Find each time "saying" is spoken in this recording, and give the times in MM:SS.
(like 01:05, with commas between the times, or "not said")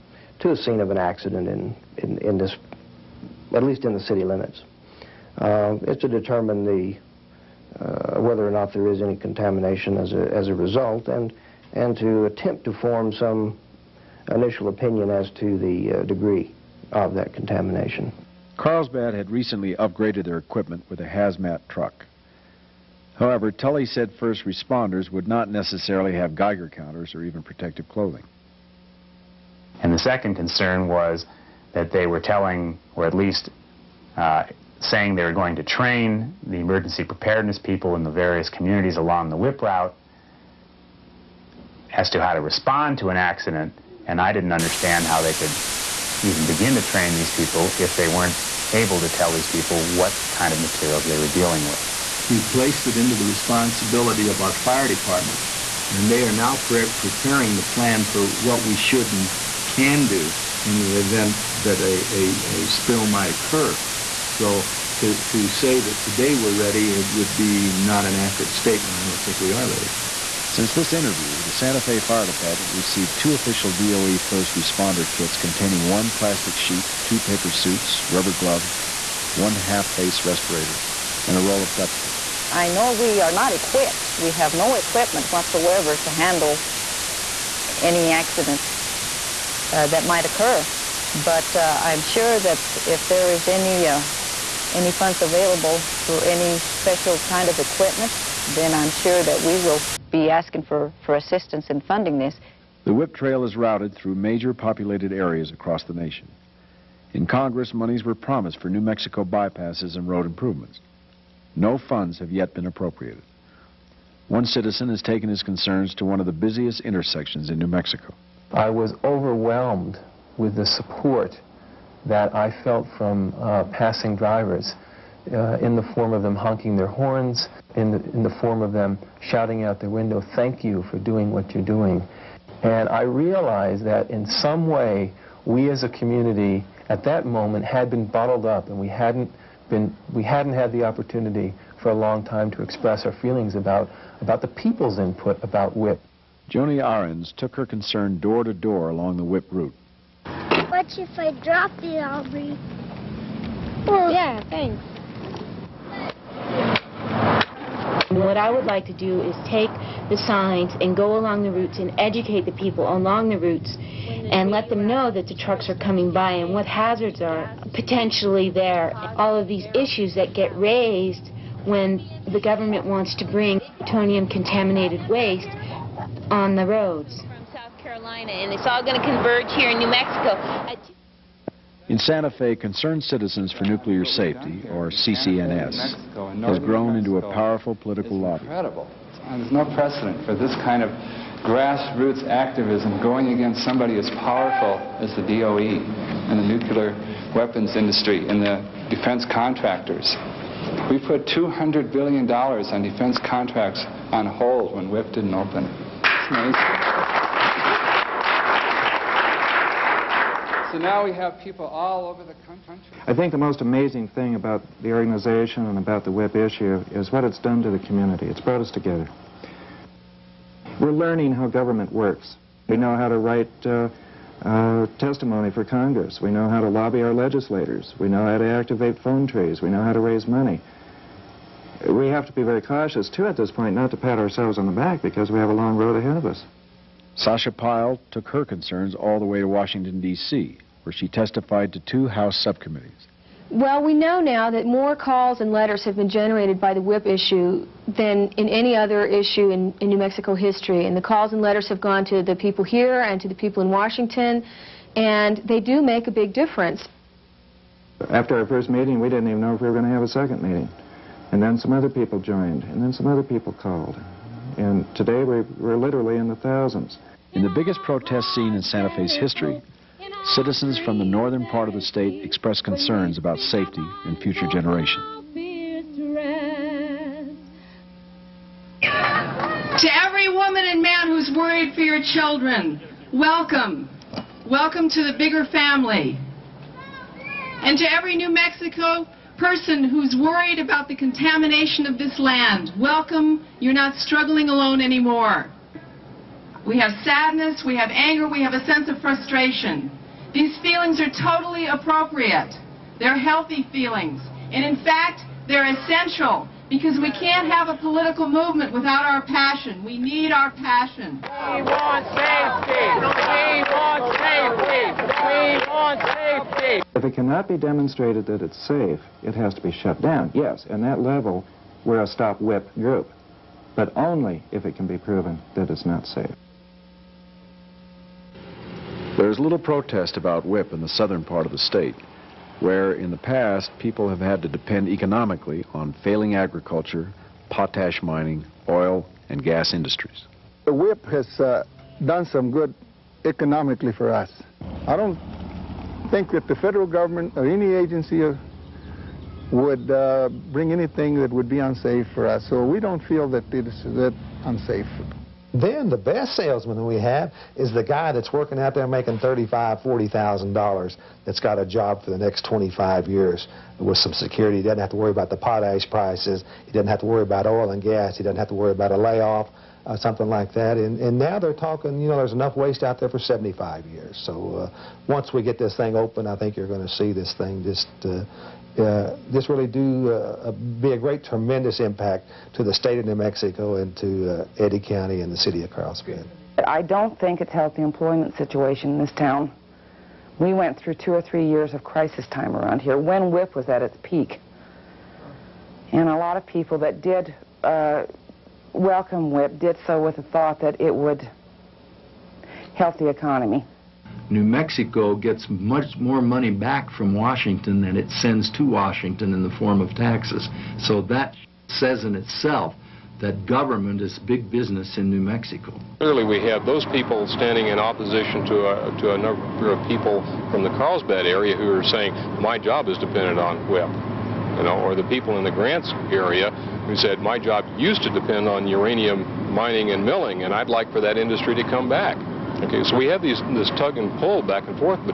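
00:34, 07:01.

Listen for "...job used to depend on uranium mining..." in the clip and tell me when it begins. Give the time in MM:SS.
07:07.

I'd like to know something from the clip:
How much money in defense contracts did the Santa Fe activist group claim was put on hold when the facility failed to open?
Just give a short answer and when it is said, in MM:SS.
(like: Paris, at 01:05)
$200 billion, at 03:21.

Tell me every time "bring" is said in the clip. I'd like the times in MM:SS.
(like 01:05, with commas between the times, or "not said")
02:53, 05:50.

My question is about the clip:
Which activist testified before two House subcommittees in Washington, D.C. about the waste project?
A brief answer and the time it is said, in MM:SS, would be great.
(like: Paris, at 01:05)
Sasha Pyle, at 03:57.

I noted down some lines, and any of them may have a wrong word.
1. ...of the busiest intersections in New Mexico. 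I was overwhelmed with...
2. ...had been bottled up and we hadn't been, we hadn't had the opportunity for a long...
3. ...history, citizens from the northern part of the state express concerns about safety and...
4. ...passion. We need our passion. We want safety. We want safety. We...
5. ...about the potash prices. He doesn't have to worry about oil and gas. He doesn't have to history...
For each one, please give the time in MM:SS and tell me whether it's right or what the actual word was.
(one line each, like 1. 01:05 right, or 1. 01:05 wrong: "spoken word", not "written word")
1. 01:56 right
2. 02:17 right
3. 04:29 right
4. 05:09 right
5. 06:05 wrong: "worry", not "history".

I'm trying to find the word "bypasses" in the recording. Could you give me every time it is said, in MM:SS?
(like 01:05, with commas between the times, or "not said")
01:49.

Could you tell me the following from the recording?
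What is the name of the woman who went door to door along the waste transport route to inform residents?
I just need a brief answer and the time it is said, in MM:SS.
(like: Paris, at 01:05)
Joni Ahrens, at 02:26.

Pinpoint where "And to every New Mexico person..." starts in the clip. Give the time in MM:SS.
04:47.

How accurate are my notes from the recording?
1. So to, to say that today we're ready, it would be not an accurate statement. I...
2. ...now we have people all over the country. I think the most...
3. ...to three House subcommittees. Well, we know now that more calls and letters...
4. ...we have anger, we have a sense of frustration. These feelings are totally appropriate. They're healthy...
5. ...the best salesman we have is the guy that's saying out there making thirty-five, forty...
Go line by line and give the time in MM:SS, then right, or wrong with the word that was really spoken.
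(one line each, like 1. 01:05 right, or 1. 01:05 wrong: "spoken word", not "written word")
1. 01:04 right
2. 03:30 right
3. 04:01 wrong: "two", not "three"
4. 04:57 right
5. 05:55 wrong: "working", not "saying".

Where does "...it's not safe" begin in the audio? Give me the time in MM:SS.
05:25.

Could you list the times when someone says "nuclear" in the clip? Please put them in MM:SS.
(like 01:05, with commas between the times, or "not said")
03:03, 03:16.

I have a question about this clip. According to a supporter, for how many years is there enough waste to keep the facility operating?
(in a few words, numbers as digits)
75 years.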